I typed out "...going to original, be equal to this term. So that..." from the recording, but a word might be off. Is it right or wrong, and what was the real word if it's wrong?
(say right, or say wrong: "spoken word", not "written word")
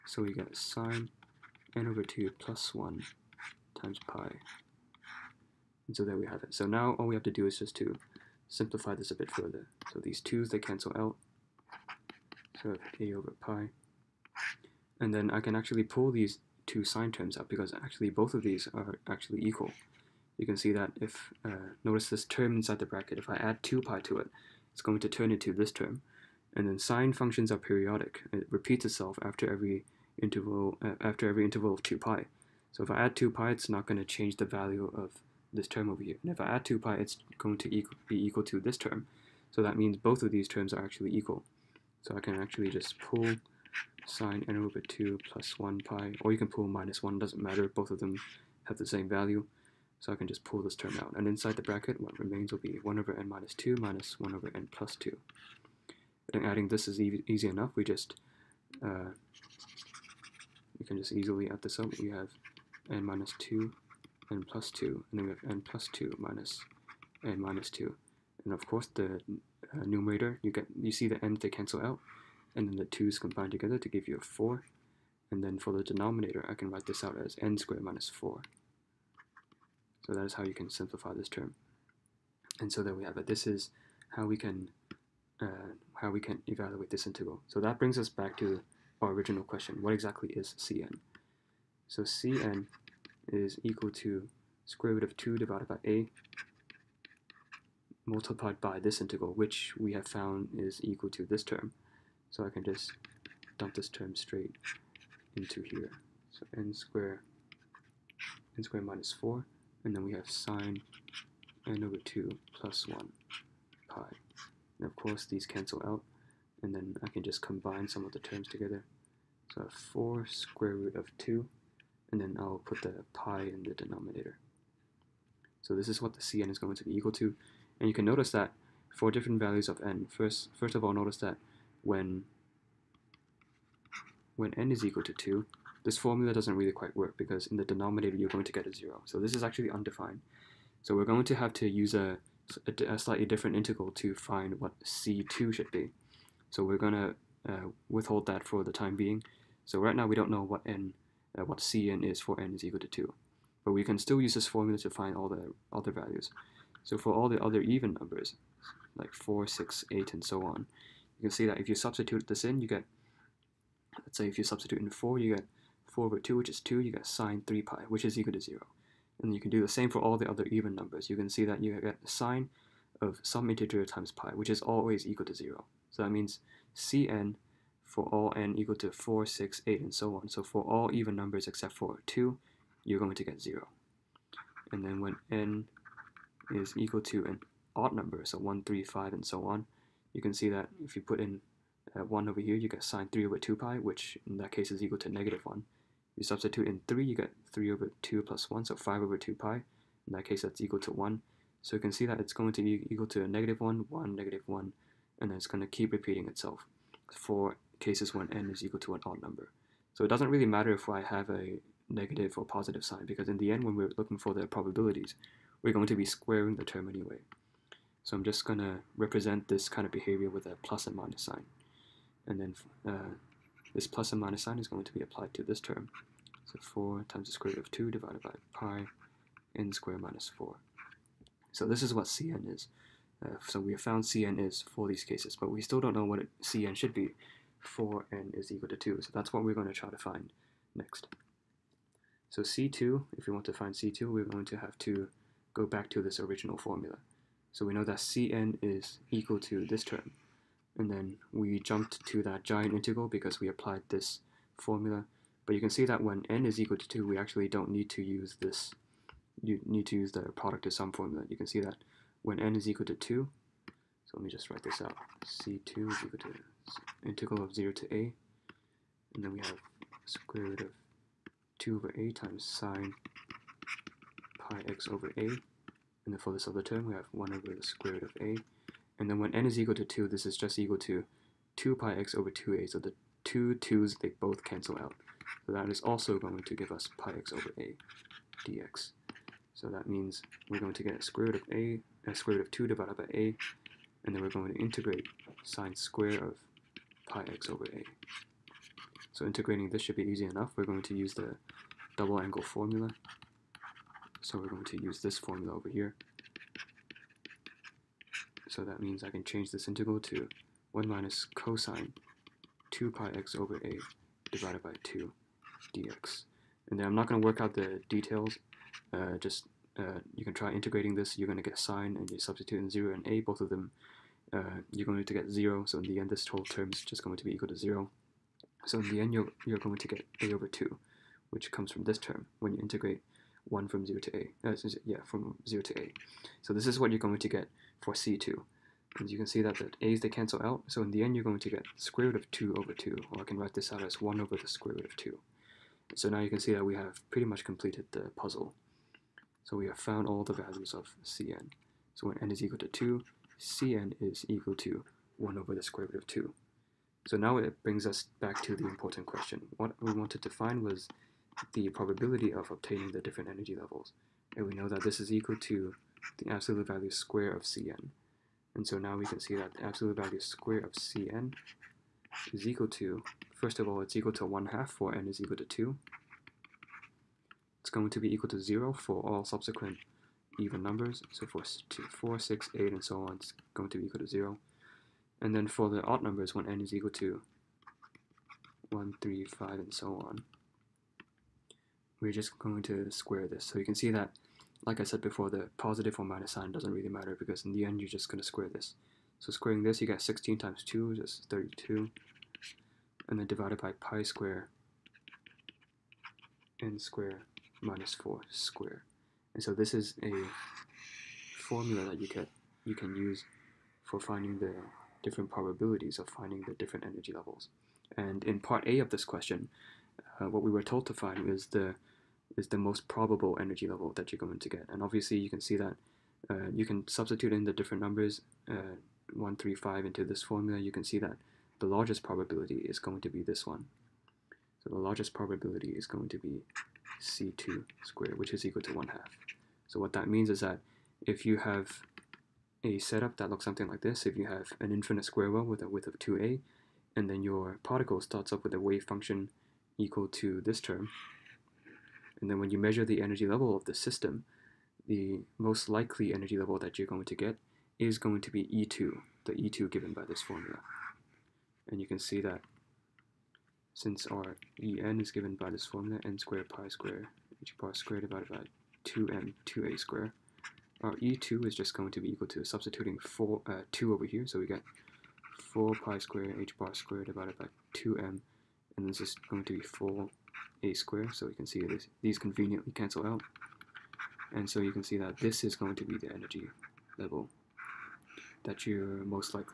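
wrong: "equal", not "original".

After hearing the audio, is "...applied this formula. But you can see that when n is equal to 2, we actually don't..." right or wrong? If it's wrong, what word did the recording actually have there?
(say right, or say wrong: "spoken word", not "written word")
right.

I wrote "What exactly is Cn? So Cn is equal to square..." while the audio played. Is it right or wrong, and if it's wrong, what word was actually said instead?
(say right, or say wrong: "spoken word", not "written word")
right.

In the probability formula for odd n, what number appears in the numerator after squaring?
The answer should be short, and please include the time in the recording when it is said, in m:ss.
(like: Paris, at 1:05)
32, at 6:41.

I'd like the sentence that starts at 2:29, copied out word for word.
So right now we don't know what n, uh, what Cn is for n is equal to 2.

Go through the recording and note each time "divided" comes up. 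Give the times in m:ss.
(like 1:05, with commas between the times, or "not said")
1:35, 3:47, 4:52, 5:14, 6:43, 7:48, 7:57.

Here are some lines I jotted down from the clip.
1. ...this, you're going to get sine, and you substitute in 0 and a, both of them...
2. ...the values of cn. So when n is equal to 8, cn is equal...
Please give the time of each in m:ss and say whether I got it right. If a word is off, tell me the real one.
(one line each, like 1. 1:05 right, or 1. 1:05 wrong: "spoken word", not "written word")
1. 5:20 right
2. 5:50 wrong: "2", not "8".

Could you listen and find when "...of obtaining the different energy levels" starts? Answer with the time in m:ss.
6:02.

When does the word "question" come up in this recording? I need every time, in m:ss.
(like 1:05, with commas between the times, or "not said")
1:29, 5:59, 6:59.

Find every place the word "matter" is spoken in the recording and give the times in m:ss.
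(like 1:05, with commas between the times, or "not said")
0:47, 3:30, 6:36.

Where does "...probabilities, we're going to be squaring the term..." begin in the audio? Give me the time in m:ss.
3:34.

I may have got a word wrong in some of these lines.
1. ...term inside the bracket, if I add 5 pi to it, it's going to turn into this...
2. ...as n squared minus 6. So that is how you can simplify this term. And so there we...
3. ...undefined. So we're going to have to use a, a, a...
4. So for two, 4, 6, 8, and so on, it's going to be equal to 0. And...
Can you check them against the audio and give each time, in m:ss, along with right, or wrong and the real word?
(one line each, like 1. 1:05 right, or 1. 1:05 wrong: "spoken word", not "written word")
1. 0:22 wrong: "2", not "5"
2. 1:17 wrong: "4", not "6"
3. 2:19 right
4. 6:21 right.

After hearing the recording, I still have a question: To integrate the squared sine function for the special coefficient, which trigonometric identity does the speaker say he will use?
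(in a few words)
double angle formula.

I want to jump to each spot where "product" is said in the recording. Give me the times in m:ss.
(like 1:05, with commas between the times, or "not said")
4:20.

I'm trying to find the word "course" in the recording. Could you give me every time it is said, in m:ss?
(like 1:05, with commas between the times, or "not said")
1:08, 1:54.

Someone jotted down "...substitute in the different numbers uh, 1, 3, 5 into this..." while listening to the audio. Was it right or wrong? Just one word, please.
right.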